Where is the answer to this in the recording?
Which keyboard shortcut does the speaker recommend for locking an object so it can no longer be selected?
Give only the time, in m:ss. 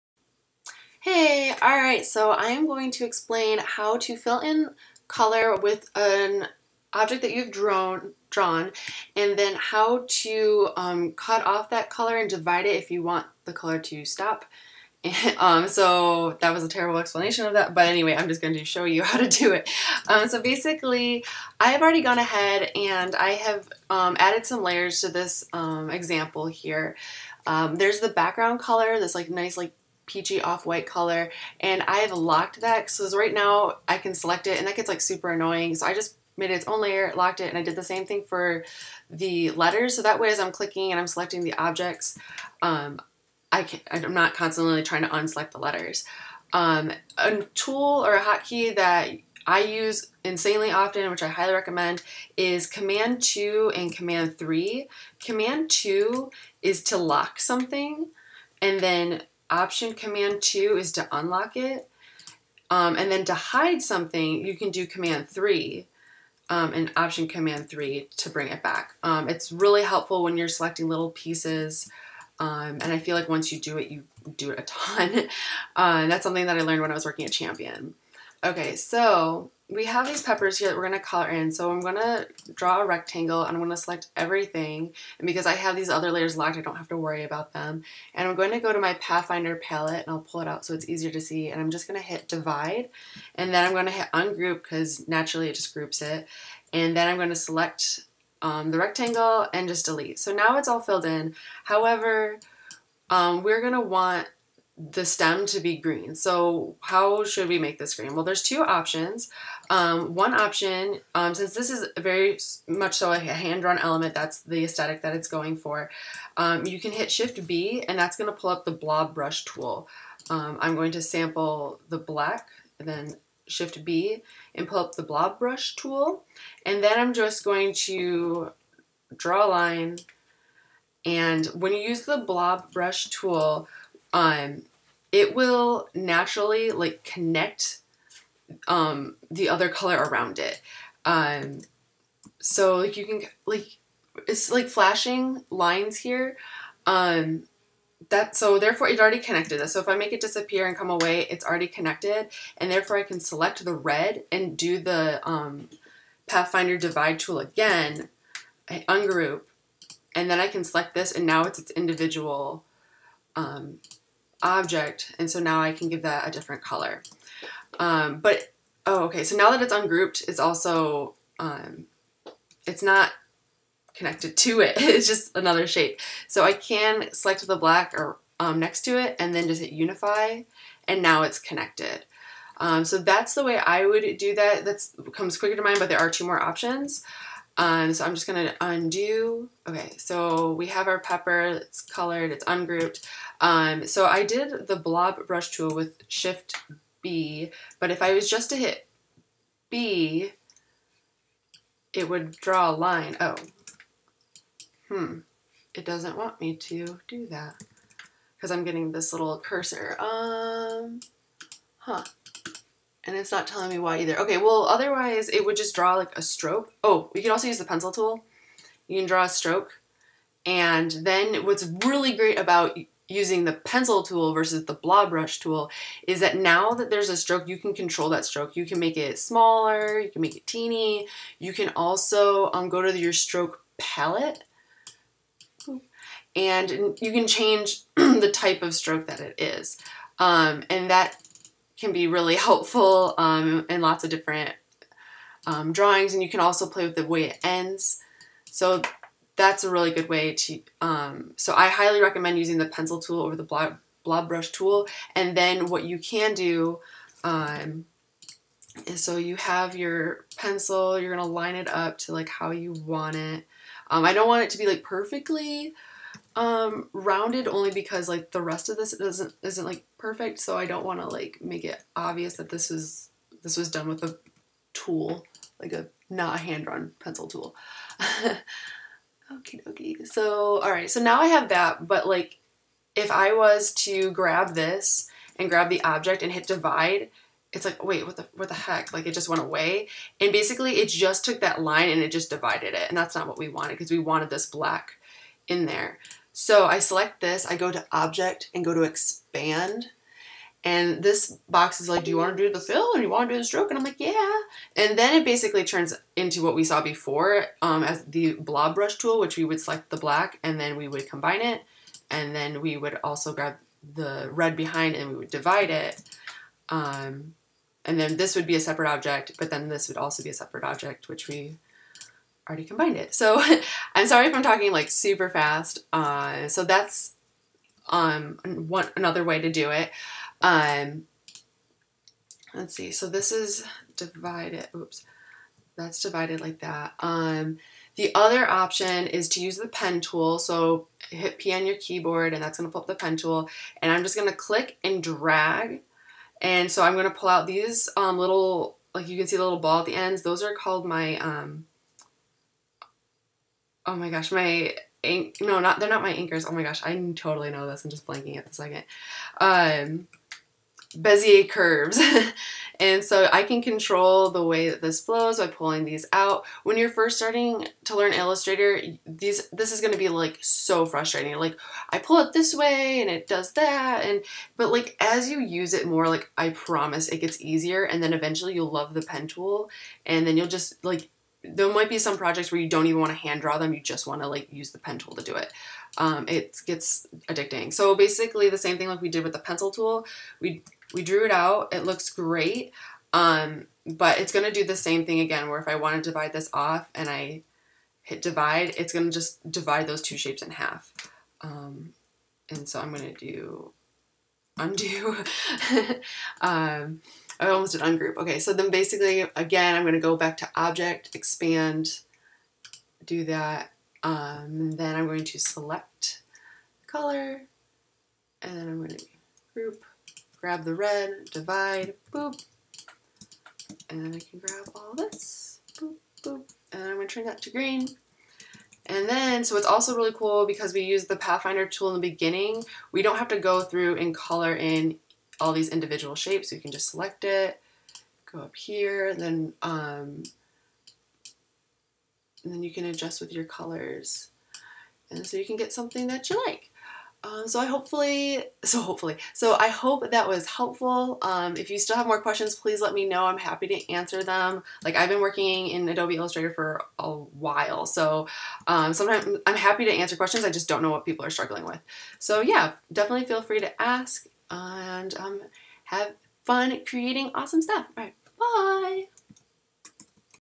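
0:55.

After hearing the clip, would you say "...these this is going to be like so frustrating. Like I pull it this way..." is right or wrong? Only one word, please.
right.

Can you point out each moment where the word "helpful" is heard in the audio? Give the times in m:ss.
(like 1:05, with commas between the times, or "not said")
1:09, 4:02, 7:30.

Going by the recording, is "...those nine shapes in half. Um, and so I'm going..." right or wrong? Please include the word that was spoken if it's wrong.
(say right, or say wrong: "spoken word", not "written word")
wrong: "two", not "nine".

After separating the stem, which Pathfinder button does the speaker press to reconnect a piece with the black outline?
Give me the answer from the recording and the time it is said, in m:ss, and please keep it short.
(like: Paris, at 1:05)
Unify, at 2:59.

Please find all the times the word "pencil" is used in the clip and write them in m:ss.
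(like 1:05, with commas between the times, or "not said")
3:37, 3:43, 4:12, 4:20, 4:36, 6:29.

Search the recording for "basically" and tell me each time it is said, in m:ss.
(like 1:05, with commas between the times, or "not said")
0:20, 4:50, 5:05, 6:27, 6:48.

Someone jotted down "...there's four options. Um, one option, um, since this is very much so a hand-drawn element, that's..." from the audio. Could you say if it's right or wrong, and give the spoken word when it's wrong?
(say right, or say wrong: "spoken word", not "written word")
wrong: "two", not "four".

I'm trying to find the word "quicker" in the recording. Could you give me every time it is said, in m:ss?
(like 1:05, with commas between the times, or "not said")
3:05.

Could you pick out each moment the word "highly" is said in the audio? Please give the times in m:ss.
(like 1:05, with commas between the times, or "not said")
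0:51, 4:11.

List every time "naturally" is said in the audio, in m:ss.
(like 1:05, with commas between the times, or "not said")
1:35, 2:15.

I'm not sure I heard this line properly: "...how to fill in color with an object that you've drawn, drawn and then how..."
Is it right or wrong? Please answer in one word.
right.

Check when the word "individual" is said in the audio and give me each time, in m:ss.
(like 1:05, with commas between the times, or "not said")
2:41, 7:15.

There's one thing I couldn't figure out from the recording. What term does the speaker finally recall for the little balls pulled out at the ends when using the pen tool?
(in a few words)
Bezier curves.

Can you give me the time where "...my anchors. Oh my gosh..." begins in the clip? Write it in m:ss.
5:56.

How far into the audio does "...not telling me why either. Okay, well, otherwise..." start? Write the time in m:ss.
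3:33.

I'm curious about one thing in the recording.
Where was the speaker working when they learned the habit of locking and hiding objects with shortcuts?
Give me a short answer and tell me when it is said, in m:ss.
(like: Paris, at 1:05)
Champion, at 1:17.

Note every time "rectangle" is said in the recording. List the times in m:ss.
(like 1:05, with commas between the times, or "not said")
1:22, 1:38.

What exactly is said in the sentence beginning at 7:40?
I just don't know what people are struggling with.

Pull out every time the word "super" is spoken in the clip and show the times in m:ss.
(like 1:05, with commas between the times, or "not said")
0:35, 5:24.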